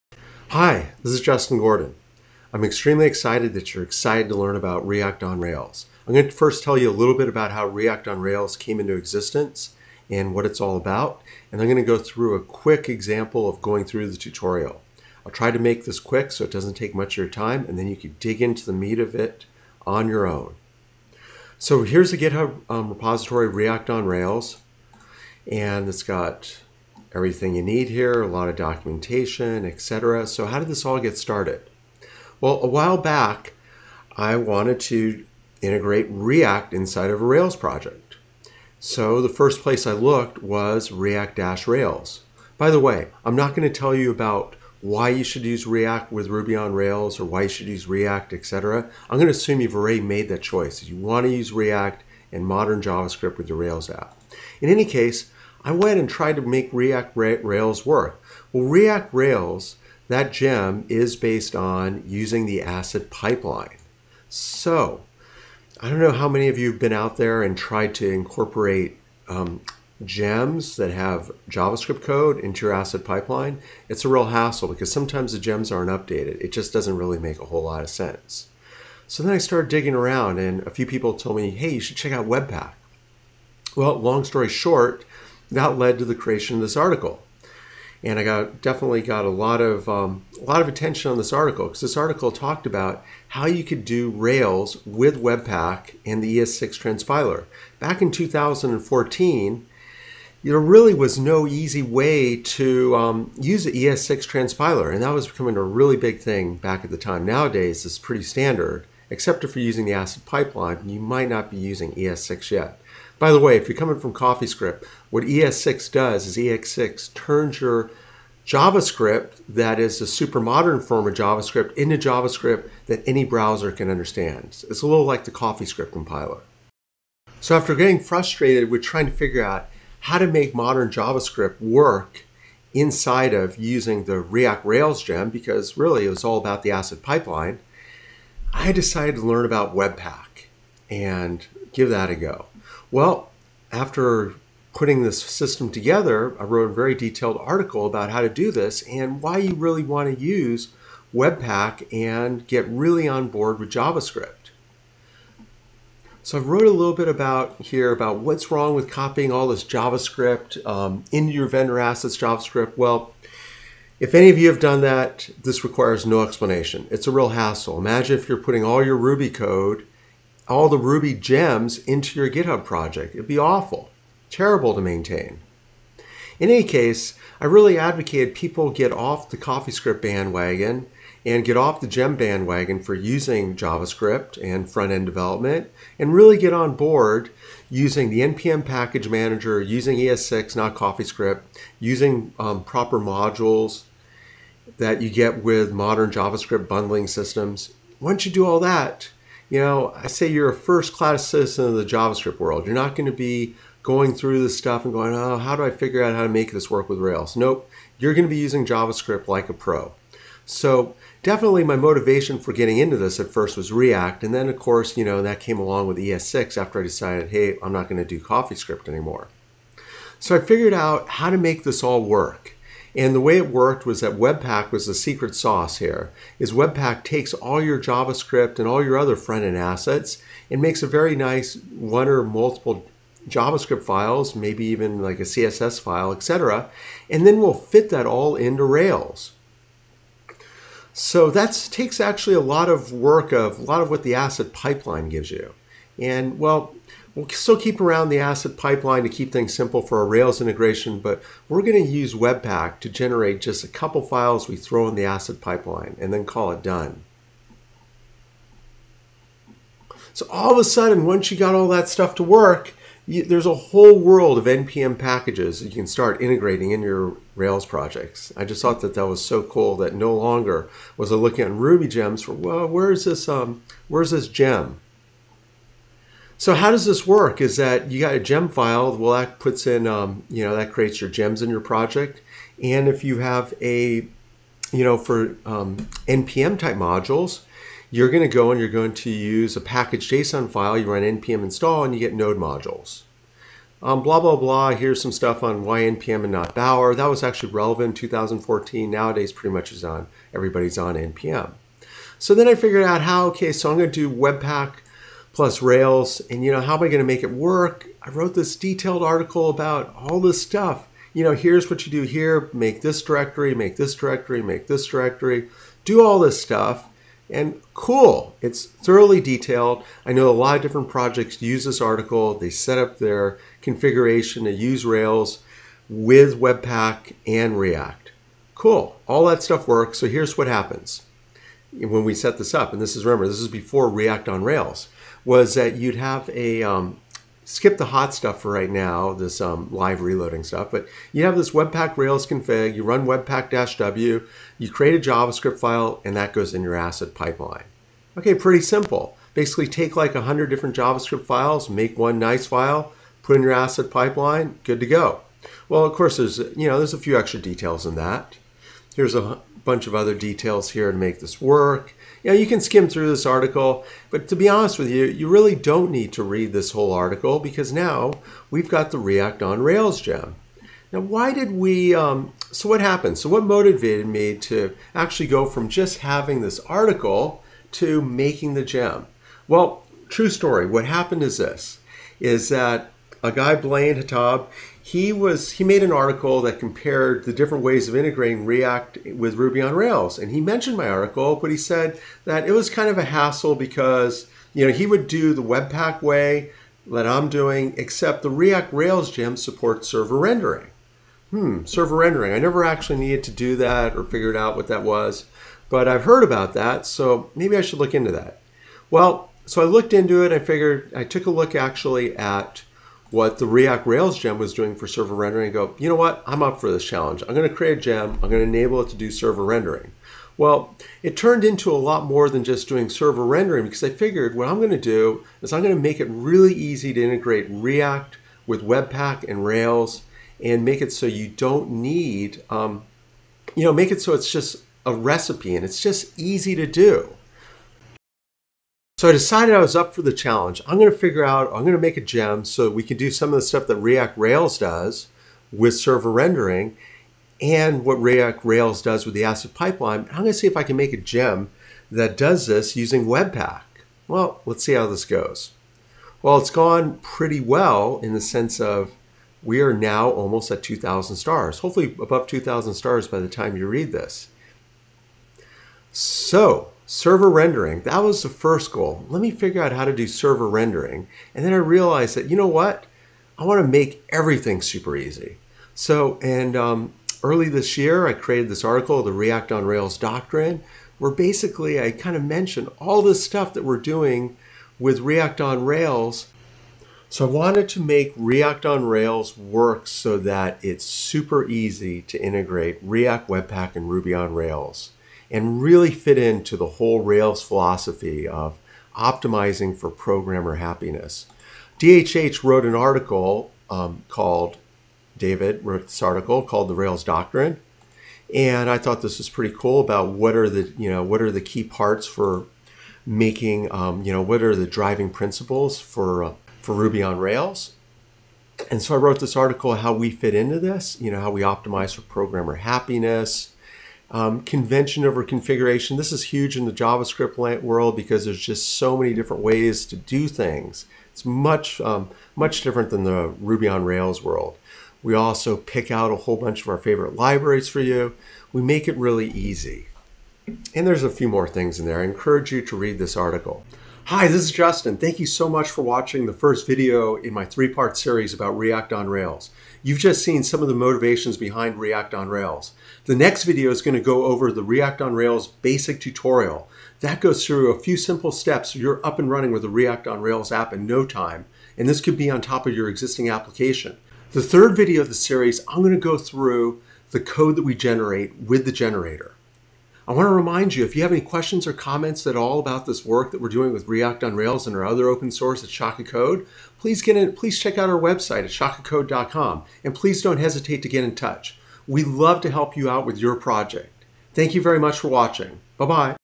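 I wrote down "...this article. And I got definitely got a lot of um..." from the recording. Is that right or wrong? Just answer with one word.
right.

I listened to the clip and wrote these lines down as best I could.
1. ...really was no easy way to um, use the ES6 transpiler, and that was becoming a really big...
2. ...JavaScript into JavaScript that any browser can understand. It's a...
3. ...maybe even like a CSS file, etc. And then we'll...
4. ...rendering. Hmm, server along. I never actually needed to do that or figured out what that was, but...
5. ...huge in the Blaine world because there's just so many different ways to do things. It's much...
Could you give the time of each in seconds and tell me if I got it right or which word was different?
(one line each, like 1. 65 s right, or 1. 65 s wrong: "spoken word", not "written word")
1. 100 s right
2. 121 s right
3. 234 s right
4. 400 s wrong: "rendering", not "along"
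5. 526 s wrong: "JavaScript", not "Blaine".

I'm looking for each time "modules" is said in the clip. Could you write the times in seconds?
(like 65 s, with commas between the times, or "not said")
192 s, 286 s, 292 s.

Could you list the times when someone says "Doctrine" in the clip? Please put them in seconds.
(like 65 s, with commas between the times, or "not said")
479 s, 507 s.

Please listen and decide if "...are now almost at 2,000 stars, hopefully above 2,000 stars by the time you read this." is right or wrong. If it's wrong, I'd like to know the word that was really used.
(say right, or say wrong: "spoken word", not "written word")
right.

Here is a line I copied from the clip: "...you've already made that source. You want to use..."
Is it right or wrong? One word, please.
wrong.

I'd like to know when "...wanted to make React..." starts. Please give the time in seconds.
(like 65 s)
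487 s.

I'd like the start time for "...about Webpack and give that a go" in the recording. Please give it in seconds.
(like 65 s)
139 s.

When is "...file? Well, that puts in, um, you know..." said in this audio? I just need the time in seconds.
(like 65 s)
278 s.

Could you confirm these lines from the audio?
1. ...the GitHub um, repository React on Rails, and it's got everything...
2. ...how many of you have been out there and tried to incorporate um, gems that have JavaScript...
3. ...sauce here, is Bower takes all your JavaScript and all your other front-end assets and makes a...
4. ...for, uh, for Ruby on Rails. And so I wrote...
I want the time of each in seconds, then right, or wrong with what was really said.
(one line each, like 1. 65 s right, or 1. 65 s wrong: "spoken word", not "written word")
1. 22 s right
2. 66 s right
3. 225 s wrong: "Webpack", not "Bower"
4. 515 s right.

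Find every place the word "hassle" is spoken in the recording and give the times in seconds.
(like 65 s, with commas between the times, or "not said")
74 s, 167 s, 393 s.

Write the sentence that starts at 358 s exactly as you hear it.
Here's a bunch of other details here to make this work.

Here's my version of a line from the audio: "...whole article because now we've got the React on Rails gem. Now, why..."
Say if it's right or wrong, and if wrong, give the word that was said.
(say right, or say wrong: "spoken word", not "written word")
right.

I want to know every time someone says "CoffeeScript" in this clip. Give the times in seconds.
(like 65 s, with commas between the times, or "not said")
114 s, 125 s, 179 s, 190 s, 218 s.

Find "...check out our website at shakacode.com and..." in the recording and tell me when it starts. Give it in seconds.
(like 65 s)
577 s.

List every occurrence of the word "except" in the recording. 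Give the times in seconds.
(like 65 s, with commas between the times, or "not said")
109 s, 397 s.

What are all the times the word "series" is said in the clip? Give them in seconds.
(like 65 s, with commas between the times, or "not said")
547 s, 565 s.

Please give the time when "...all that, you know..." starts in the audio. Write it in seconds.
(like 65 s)
198 s.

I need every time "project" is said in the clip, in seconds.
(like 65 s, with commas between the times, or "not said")
37 s, 172 s, 267 s, 281 s, 320 s, 583 s.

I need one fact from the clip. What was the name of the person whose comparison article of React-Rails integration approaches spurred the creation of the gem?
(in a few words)
Blaine Hatab.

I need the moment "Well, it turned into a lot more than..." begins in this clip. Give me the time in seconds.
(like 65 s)
420 s.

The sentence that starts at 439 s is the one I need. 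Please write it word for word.
So I decided I was up for the challenge.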